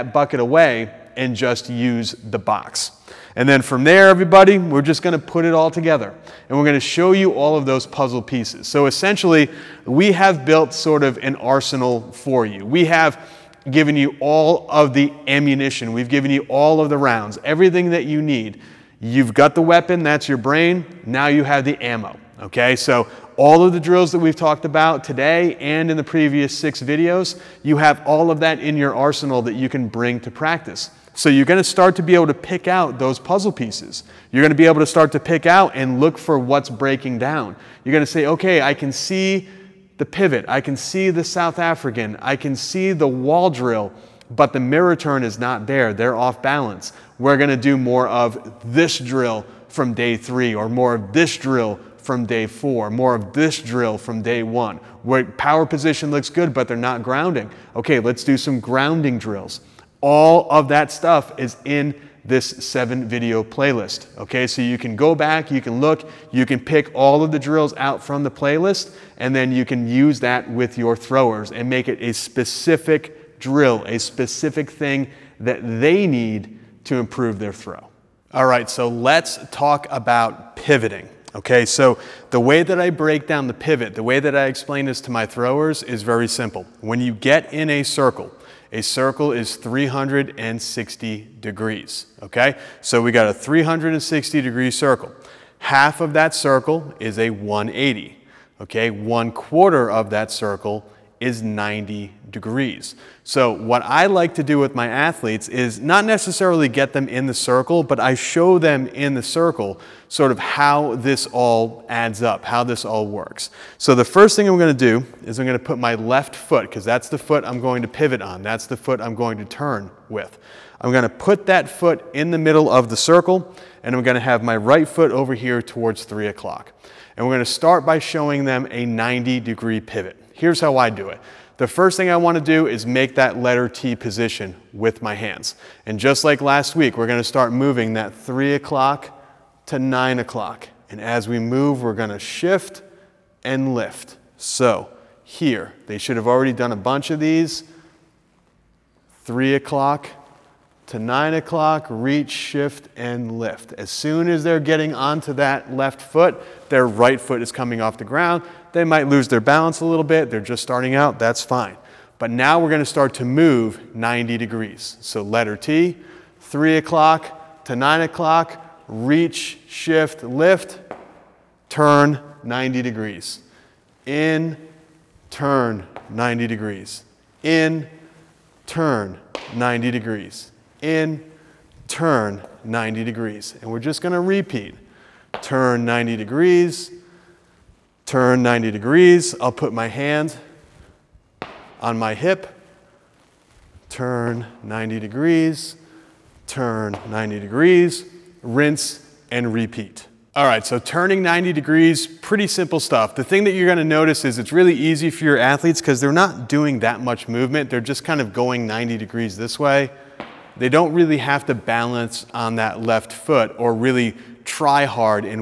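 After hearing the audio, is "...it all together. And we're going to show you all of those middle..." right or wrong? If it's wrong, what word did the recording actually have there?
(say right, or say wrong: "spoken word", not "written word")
wrong: "puzzle", not "middle".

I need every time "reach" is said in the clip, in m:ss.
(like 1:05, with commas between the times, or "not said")
2:31, 2:48.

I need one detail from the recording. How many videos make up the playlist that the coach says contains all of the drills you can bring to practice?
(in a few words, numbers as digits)
7.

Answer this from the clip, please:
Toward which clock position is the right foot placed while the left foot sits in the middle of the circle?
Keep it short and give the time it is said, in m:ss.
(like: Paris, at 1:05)
3 o'clock, at 2:06.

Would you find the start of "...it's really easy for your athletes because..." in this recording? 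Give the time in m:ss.
3:24.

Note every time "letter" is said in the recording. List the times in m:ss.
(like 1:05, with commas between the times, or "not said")
2:13, 2:45.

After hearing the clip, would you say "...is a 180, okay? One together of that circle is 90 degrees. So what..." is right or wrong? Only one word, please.
wrong.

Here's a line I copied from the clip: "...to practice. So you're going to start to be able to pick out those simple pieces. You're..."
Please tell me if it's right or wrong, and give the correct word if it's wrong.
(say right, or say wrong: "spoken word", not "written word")
wrong: "puzzle", not "simple".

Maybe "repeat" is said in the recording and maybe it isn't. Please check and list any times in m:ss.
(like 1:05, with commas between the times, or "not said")
3:04, 3:19.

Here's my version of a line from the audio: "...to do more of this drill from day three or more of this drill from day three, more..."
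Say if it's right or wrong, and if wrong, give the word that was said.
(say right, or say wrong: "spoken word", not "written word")
wrong: "four", not "three".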